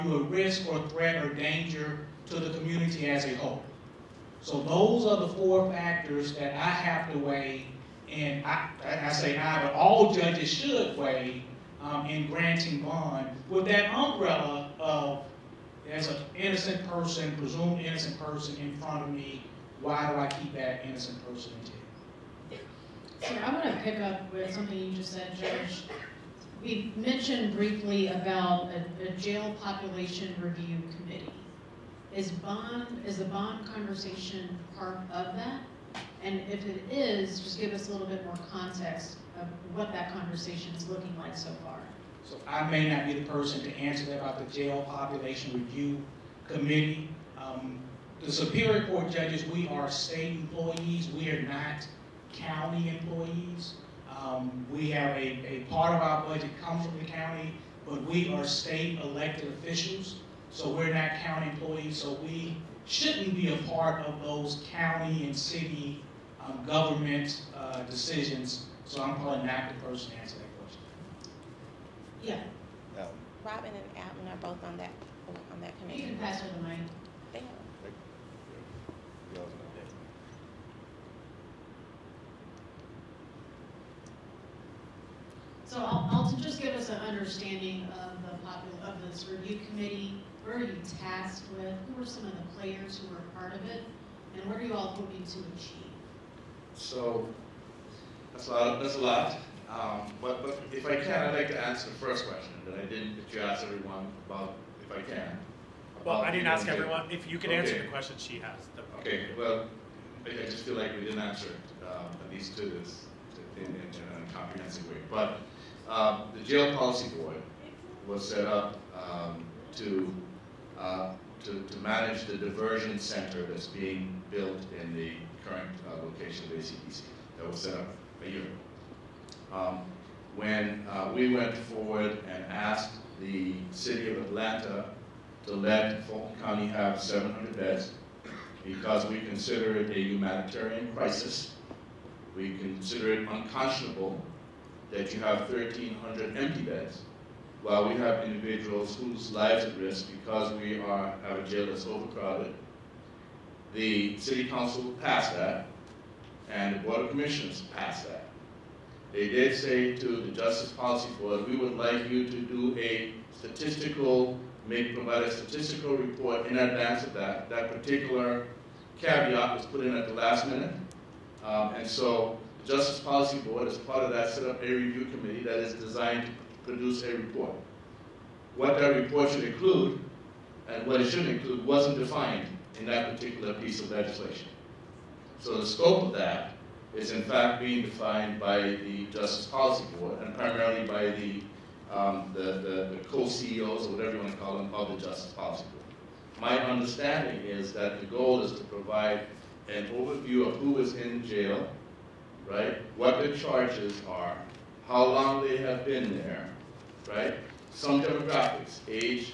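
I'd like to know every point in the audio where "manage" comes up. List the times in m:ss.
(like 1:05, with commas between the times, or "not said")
2:01.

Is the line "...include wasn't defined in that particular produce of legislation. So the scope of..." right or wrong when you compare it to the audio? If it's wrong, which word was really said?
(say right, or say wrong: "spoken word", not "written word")
wrong: "piece", not "produce".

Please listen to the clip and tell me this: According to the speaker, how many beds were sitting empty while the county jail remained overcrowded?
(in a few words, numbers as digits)
1,300.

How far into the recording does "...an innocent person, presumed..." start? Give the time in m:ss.
0:16.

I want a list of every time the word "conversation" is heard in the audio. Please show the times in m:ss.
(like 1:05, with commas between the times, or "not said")
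0:33, 0:40.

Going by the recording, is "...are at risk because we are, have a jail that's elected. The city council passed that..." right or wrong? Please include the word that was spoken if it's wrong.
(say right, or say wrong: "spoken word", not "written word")
wrong: "overcrowded", not "elected".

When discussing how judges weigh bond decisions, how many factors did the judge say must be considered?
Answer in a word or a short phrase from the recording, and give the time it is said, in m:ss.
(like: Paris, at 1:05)
4, at 0:05.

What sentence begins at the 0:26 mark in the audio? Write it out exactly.
We mentioned briefly about a, a jail population review committee.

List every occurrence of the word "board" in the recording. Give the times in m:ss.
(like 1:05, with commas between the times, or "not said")
1:57, 2:36, 2:41, 2:53, 3:09, 3:15.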